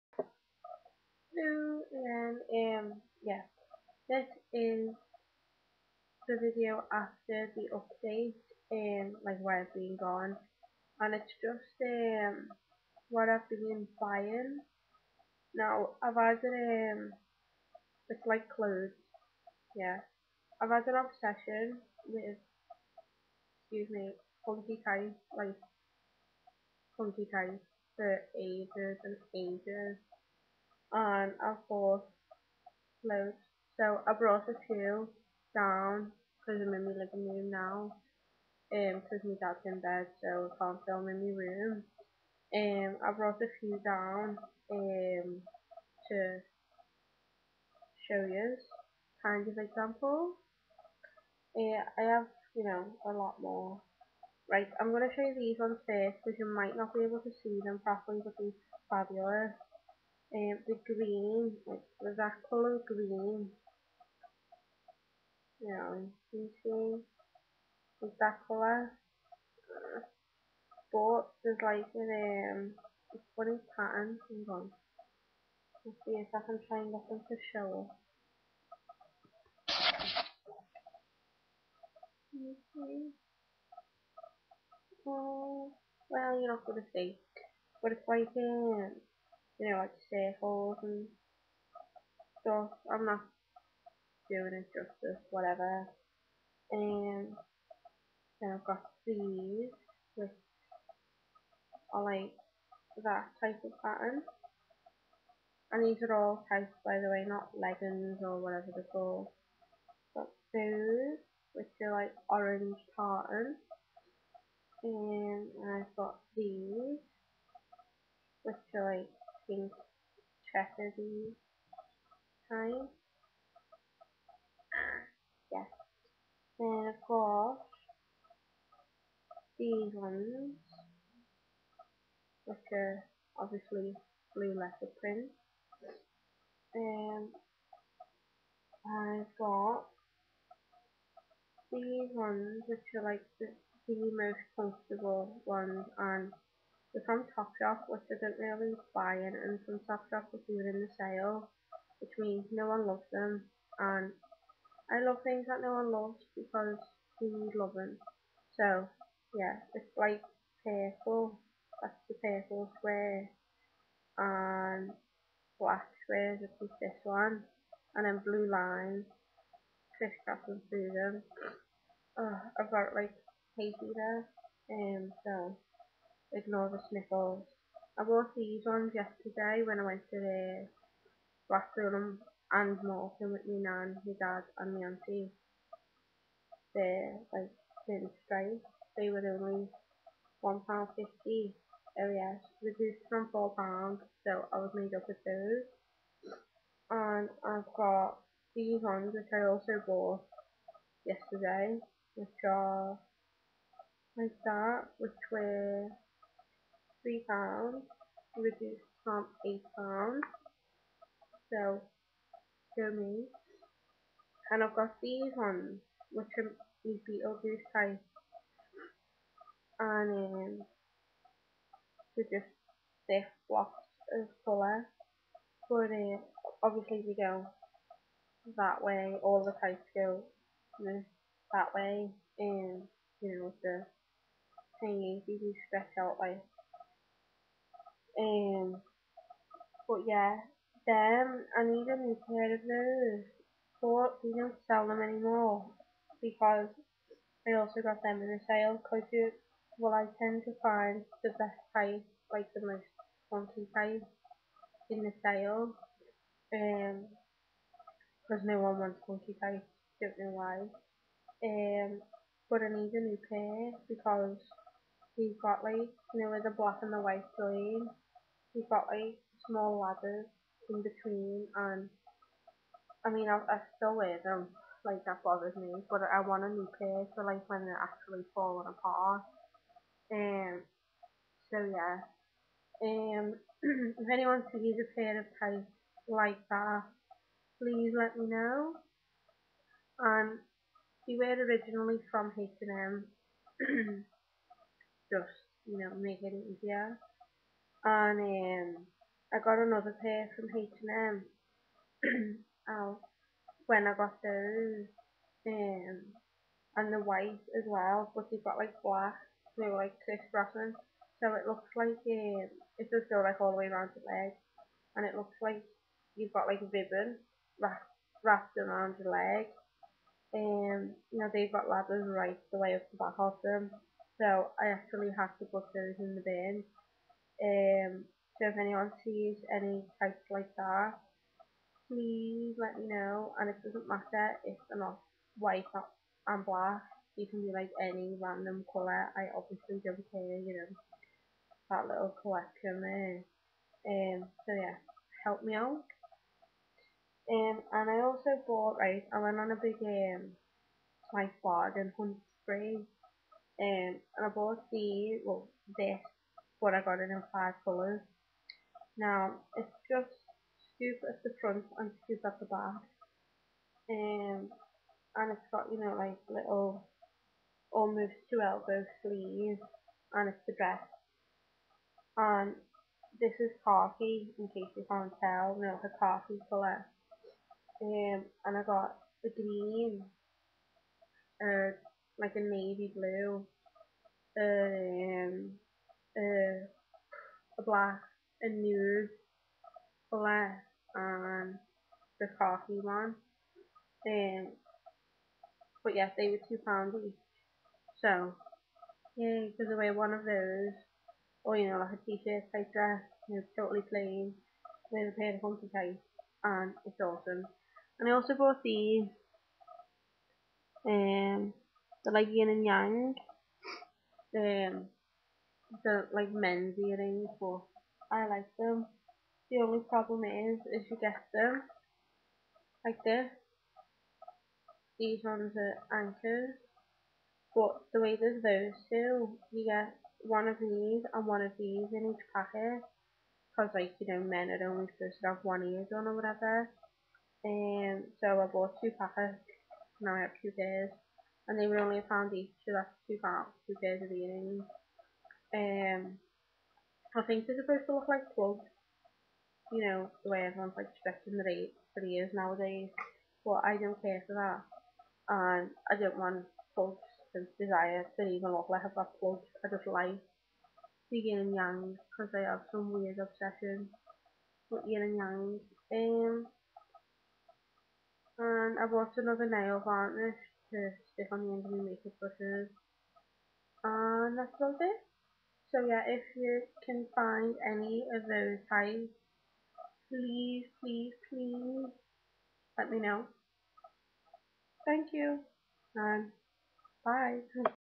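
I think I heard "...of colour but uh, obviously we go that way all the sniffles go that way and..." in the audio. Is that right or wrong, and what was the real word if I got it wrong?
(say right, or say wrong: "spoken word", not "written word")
wrong: "types", not "sniffles".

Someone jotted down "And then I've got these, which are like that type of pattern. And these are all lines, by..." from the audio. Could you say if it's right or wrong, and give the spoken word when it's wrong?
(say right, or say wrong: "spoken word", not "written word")
wrong: "types", not "lines".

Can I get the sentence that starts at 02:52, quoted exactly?
Oh, I've got like Haiti there, and um, so ignore the sniffles.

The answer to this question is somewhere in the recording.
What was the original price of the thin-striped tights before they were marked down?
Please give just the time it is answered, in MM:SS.
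03:13.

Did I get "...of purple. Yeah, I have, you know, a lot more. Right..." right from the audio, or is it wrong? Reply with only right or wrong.
wrong.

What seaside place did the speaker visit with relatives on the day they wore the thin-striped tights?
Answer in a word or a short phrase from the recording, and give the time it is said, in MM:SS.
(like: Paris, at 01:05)
Morecambe, at 03:02.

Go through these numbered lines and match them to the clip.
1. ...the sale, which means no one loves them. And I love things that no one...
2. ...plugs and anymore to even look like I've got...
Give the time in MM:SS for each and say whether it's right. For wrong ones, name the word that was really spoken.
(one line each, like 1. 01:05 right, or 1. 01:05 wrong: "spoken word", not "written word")
1. 02:30 right
2. 07:36 wrong: "desire", not "anymore".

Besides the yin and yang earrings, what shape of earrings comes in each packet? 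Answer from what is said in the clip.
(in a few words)
Anchors.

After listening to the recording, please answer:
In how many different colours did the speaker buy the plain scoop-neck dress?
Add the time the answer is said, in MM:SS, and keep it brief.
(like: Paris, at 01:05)
5, at 05:57.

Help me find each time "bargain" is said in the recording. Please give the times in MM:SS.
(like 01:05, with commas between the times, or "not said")
05:51.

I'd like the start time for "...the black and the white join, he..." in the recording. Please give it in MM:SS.
04:26.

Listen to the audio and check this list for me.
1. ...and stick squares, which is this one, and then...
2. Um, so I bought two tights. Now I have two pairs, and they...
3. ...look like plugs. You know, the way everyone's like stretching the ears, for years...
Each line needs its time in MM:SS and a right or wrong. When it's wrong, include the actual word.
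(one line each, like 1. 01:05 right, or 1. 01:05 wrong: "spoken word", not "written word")
1. 02:44 wrong: "black", not "stick"
2. 07:17 wrong: "packets", not "tights"
3. 07:27 right.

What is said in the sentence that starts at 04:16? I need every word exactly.
Eh, um, because no one wants funky price.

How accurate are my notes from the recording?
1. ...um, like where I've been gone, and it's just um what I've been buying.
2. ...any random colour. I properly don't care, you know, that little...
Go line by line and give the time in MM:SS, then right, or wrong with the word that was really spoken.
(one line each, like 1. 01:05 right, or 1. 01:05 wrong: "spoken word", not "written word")
1. 00:08 right
2. 05:37 wrong: "obviously", not "properly".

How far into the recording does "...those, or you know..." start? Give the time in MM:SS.
06:40.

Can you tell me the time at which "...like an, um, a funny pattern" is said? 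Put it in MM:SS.
01:11.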